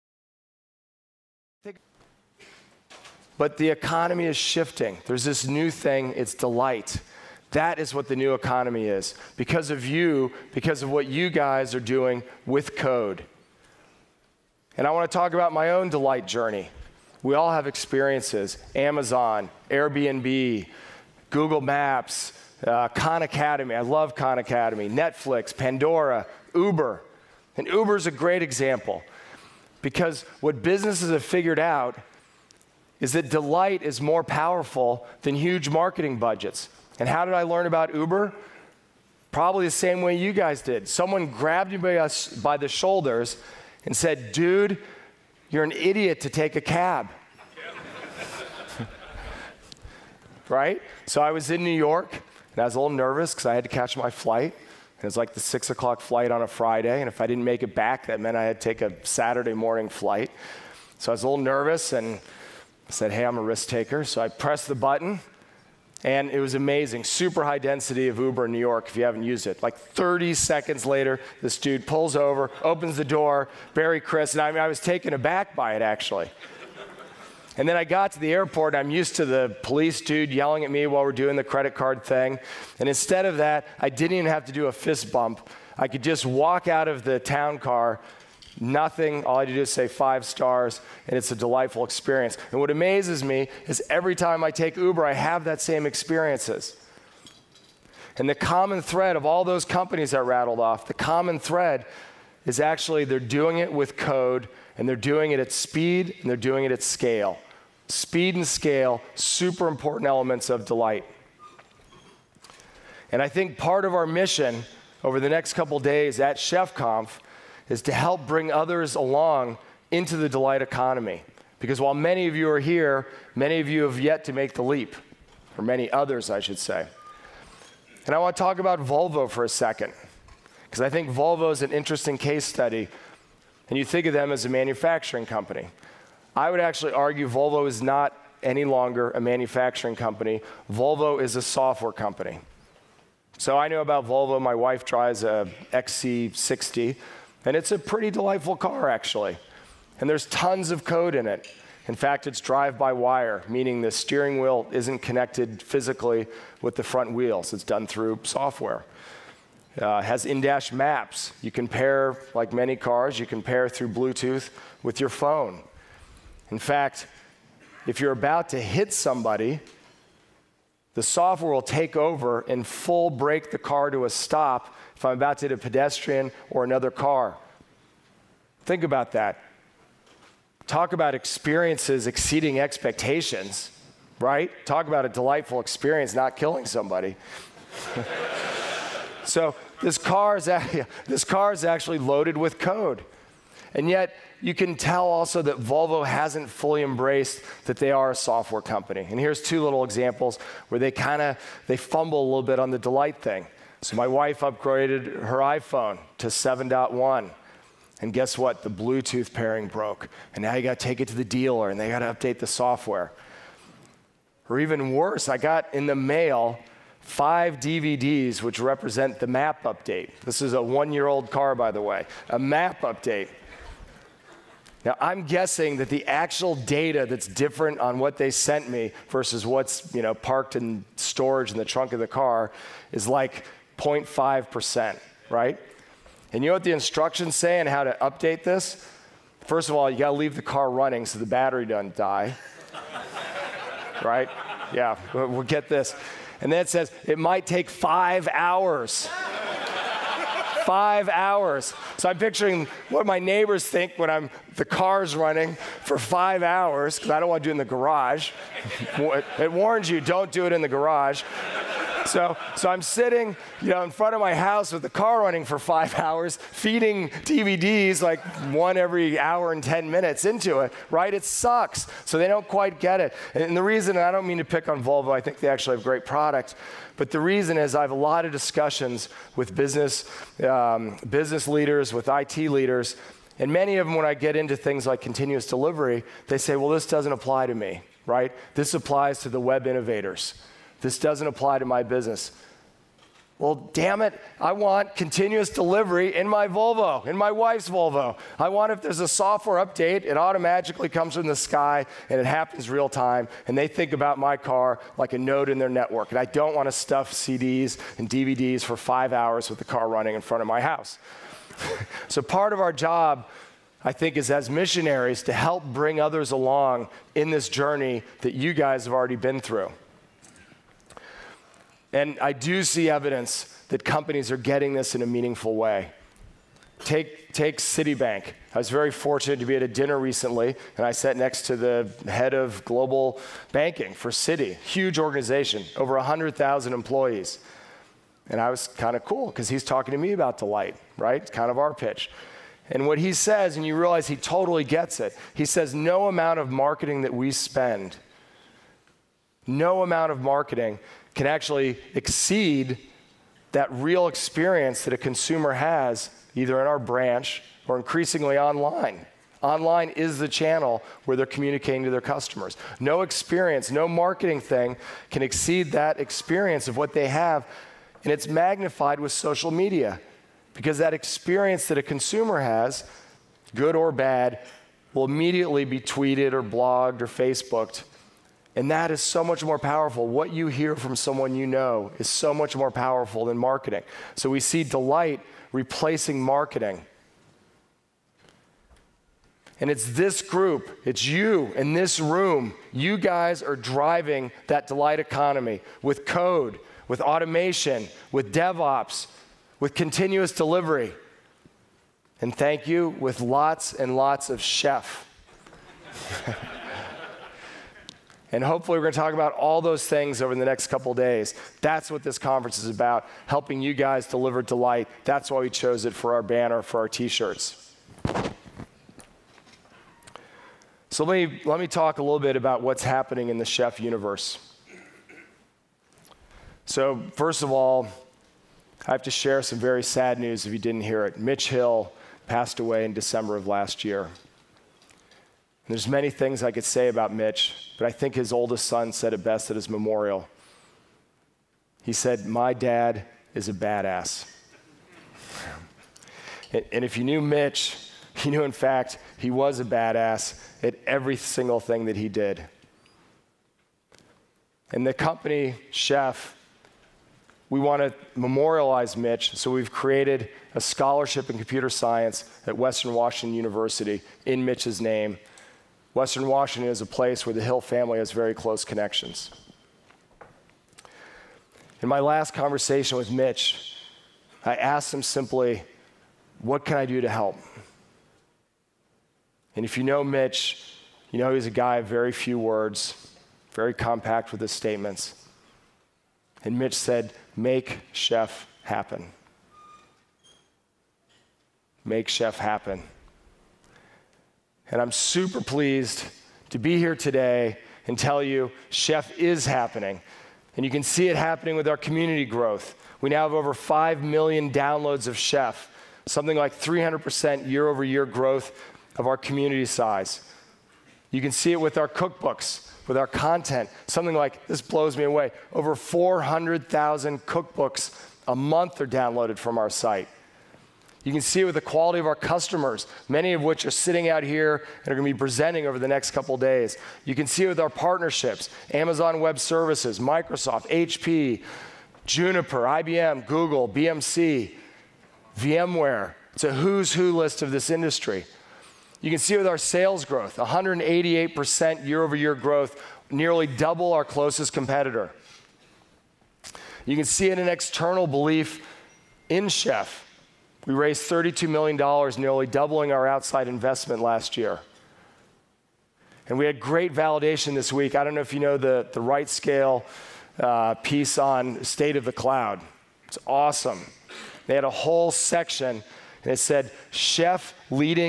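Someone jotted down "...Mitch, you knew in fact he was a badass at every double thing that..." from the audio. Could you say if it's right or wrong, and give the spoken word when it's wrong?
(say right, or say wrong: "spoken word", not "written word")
wrong: "single", not "double".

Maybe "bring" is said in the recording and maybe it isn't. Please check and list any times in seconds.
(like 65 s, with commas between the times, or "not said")
118 s, 315 s.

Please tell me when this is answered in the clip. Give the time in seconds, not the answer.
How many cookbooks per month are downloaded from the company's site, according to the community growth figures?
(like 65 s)
515 s.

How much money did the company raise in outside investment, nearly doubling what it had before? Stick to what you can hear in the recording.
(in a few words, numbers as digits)
$32 million.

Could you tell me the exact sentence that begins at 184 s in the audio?
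Talk about a delightful experience not killing somebody.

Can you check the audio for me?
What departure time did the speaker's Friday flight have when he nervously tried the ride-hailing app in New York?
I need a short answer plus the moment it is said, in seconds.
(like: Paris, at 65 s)
6 o'clock, at 55 s.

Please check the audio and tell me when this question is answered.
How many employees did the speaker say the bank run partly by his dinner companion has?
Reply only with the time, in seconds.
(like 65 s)
335 s.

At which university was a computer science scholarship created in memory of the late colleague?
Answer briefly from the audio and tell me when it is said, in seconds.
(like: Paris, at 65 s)
Western Washington University, at 462 s.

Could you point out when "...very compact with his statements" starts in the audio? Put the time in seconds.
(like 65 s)
483 s.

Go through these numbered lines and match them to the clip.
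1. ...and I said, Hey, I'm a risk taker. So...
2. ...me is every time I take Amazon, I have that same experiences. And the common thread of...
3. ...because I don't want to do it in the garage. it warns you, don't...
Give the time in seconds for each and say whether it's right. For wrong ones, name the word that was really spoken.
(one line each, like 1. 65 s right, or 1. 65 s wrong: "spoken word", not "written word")
1. 61 s right
2. 93 s wrong: "Uber", not "Amazon"
3. 256 s right.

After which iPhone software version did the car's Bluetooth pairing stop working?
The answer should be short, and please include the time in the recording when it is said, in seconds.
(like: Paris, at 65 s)
7.1, at 206 s.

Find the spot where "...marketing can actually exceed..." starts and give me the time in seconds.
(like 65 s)
350 s.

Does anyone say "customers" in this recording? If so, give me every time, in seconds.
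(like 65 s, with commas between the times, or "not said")
362 s, 522 s.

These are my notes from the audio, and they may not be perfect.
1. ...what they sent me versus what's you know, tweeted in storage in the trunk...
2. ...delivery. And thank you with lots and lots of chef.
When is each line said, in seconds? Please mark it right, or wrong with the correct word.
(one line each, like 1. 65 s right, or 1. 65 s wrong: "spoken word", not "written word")
1. 227 s wrong: "parked", not "tweeted"
2. 400 s right.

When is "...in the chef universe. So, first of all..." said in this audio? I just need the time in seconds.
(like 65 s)
423 s.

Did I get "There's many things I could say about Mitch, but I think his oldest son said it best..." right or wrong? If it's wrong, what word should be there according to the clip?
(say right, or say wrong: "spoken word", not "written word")
right.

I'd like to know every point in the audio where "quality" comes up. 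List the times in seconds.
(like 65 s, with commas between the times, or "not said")
521 s.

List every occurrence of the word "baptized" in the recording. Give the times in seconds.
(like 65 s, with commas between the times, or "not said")
not said.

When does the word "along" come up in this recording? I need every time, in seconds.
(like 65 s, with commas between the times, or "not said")
118 s, 316 s.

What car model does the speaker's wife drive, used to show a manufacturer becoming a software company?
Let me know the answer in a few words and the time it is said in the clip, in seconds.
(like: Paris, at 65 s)
XC60, at 145 s.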